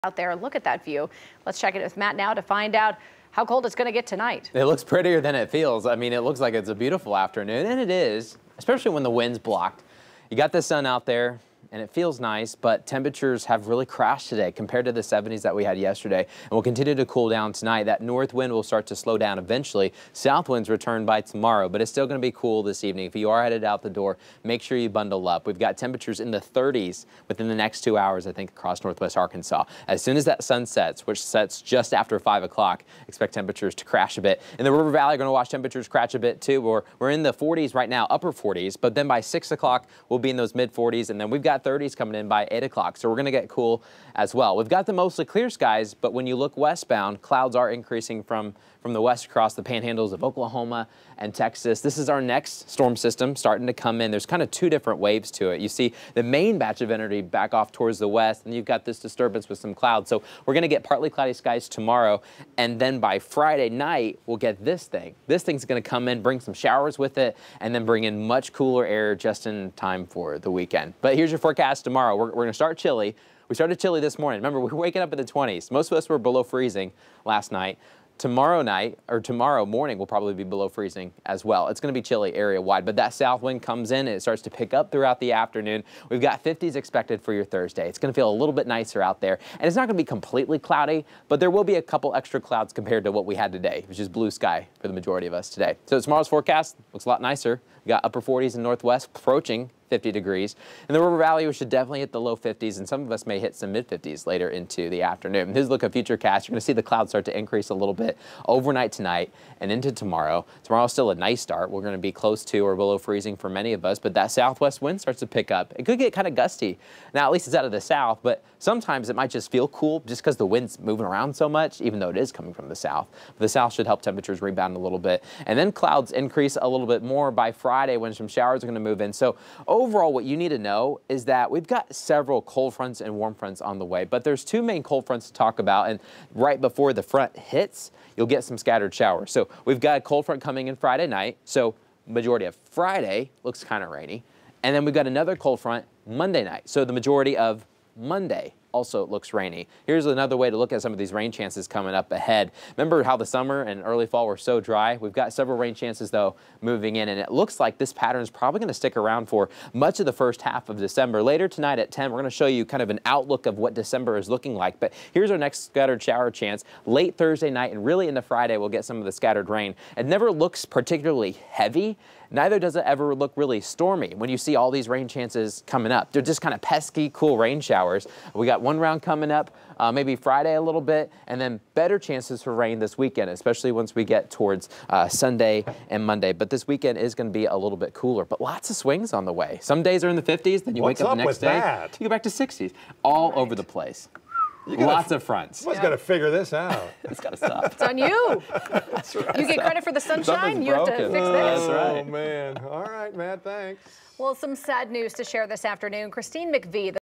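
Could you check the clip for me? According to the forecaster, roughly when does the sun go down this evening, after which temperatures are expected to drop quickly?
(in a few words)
Just after 5 o'clock.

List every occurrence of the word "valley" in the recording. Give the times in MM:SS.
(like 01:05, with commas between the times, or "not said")
00:34, 01:41.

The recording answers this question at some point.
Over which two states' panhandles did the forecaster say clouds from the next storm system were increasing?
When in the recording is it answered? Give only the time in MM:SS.
00:50.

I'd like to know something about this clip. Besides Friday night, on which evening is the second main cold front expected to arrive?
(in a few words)
Monday night.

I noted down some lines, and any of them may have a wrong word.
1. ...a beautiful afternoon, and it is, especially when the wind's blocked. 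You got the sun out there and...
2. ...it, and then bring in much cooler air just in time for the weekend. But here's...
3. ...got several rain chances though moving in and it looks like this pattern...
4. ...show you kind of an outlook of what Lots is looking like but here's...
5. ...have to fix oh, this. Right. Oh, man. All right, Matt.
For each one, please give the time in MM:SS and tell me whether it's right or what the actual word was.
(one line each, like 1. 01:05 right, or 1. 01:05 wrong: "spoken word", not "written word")
1. 00:06 right
2. 01:07 right
3. 02:35 right
4. 02:42 wrong: "December", not "Lots"
5. 03:20 right.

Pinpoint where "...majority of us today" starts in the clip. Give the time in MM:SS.
01:34.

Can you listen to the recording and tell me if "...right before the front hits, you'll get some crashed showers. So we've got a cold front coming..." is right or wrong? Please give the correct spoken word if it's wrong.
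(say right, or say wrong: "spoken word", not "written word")
wrong: "scattered", not "crashed".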